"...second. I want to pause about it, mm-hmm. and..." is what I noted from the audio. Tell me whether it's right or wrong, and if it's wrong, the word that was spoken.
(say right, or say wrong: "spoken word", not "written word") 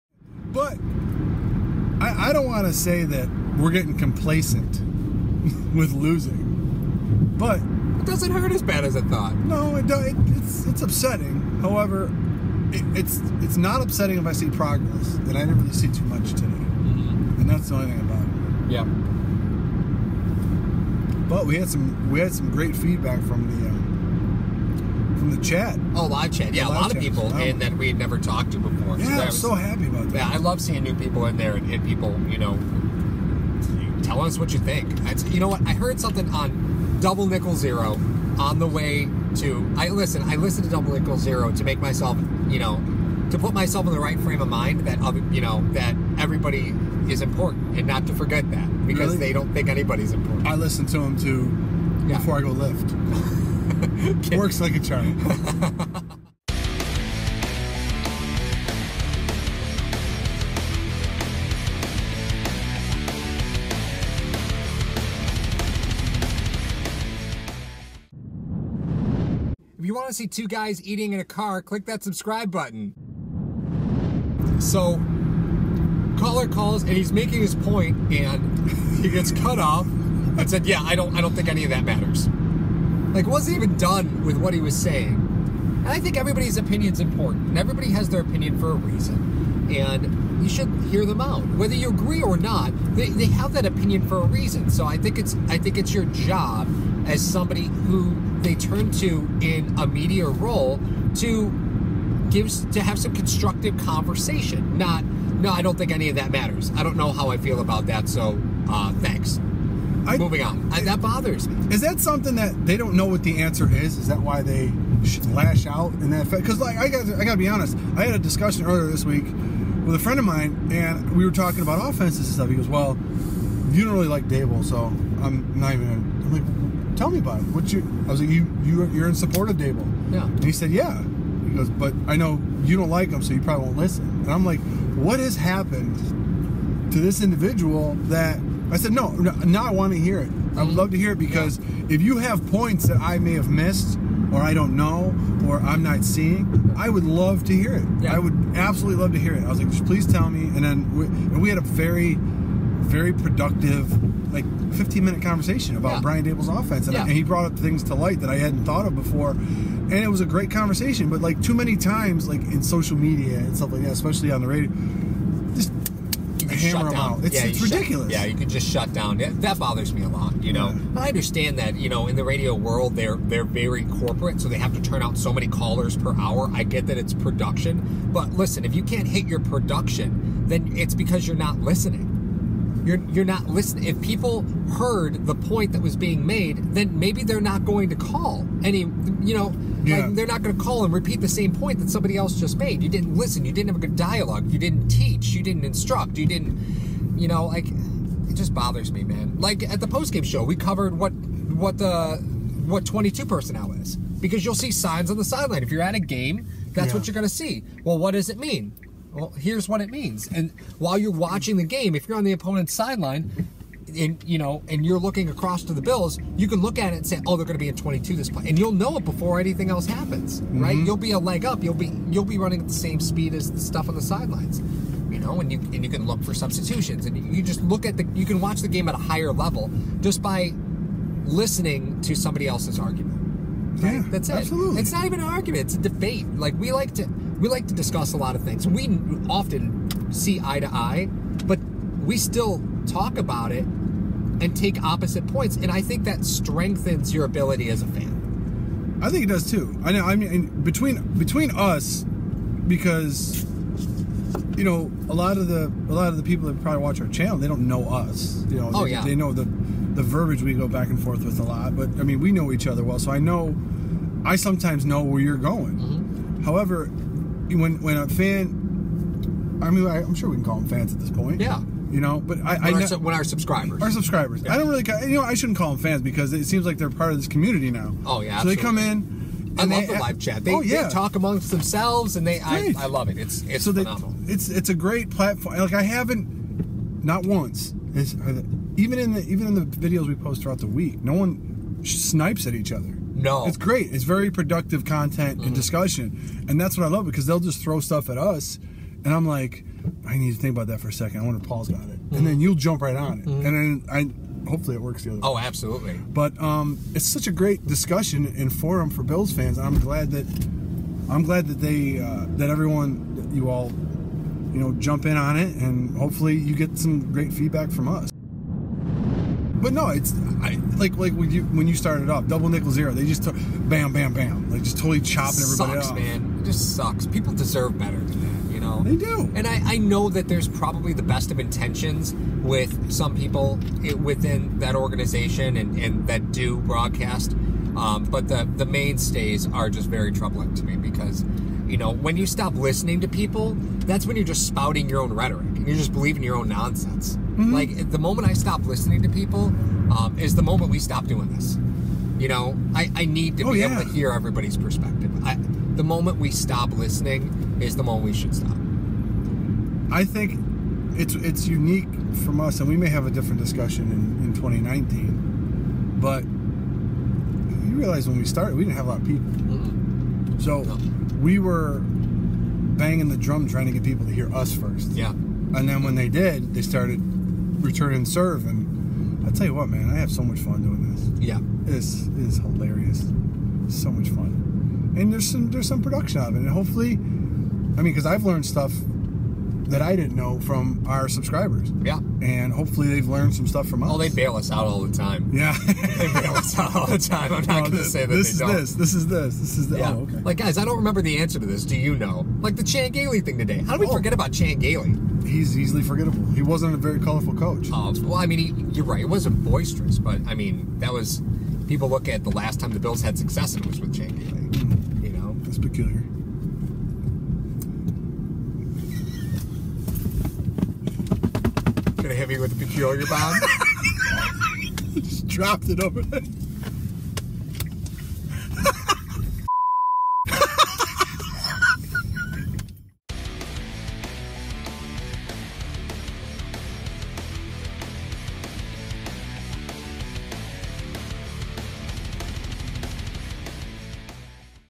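right.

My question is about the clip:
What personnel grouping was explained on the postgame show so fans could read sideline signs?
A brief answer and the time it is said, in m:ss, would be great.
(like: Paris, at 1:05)
22 personnel, at 3:22.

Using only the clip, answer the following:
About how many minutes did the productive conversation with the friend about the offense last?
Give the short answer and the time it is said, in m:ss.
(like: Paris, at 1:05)
15, at 2:34.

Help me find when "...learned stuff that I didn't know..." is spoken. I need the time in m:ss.
6:28.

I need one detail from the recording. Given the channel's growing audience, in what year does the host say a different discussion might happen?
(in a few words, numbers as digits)
2019.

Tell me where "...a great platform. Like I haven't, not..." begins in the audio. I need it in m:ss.
4:44.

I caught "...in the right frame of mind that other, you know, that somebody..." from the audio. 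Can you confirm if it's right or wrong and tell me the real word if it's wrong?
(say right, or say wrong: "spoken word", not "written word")
wrong: "everybody", not "somebody".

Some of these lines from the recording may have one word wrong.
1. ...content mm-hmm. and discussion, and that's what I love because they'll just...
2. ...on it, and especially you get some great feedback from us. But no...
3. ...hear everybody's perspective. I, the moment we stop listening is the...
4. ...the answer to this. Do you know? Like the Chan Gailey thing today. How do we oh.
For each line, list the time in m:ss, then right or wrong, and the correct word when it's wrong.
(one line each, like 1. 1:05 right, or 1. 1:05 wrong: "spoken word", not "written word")
1. 4:54 right
2. 5:15 wrong: "hopefully", not "especially"
3. 5:53 right
4. 6:41 right.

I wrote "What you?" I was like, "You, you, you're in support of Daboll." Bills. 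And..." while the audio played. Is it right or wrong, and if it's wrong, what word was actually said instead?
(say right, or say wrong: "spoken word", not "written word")
wrong: "Yeah", not "Bills".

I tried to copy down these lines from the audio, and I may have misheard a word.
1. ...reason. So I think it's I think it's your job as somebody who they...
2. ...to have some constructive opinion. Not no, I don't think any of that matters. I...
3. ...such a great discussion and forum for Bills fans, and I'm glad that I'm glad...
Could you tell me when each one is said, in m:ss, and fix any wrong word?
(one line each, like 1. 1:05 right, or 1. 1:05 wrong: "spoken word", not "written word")
1. 1:34 right
2. 1:42 wrong: "conversation", not "opinion"
3. 5:07 right.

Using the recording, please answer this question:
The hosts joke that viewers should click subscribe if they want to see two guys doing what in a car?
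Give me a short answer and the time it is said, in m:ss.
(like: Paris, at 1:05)
eating, at 1:10.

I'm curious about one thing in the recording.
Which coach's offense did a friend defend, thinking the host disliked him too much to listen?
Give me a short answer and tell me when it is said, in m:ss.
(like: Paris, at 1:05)
Brian Daboll, at 2:36.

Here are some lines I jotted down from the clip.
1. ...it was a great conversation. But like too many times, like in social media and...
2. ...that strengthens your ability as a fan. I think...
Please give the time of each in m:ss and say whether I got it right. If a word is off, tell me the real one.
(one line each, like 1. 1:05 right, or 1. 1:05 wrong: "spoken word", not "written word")
1. 2:39 right
2. 4:06 right.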